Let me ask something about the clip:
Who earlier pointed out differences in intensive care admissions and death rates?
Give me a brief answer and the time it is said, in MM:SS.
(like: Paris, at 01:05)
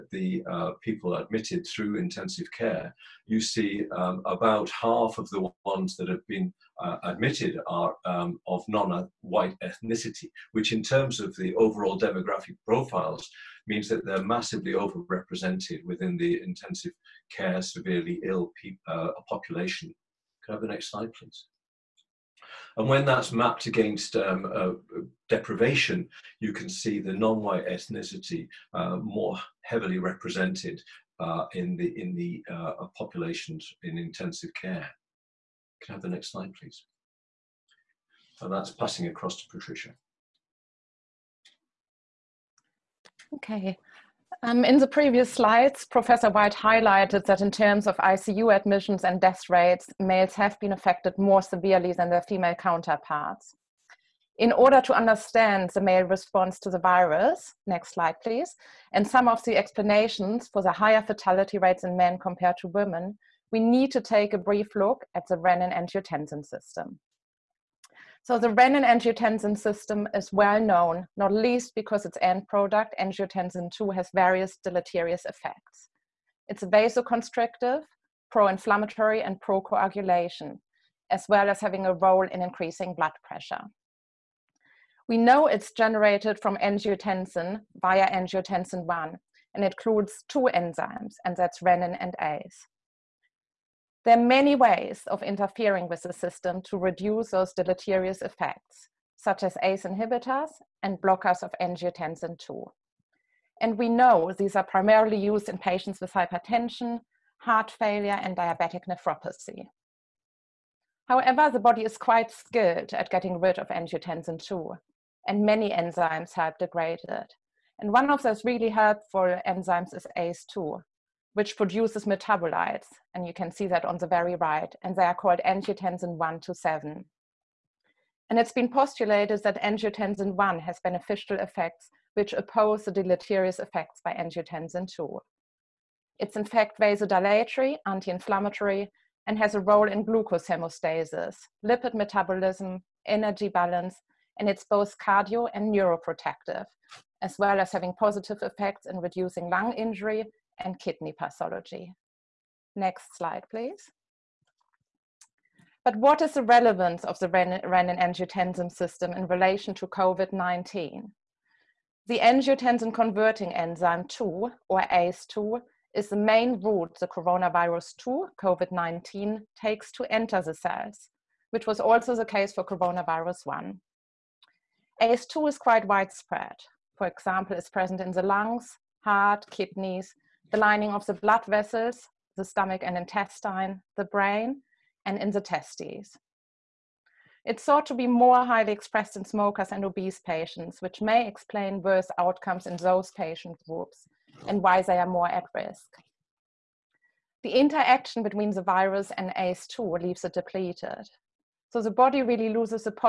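Professor White, at 00:45.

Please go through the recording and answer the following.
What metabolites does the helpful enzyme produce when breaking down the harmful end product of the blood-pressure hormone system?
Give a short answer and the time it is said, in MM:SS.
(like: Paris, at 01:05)
angiotensin 1 to 7, at 02:05.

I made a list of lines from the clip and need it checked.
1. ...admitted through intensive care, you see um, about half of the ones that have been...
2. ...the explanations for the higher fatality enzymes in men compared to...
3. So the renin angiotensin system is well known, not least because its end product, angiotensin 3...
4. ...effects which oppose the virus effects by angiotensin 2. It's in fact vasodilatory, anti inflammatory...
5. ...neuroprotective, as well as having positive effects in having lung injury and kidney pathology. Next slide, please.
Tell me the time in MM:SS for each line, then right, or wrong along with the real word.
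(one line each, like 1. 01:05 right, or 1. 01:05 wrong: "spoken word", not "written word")
1. 00:01 right
2. 00:59 wrong: "rates", not "enzymes"
3. 01:08 wrong: "2", not "3"
4. 02:11 wrong: "deleterious", not "virus"
5. 02:25 wrong: "reducing", not "having".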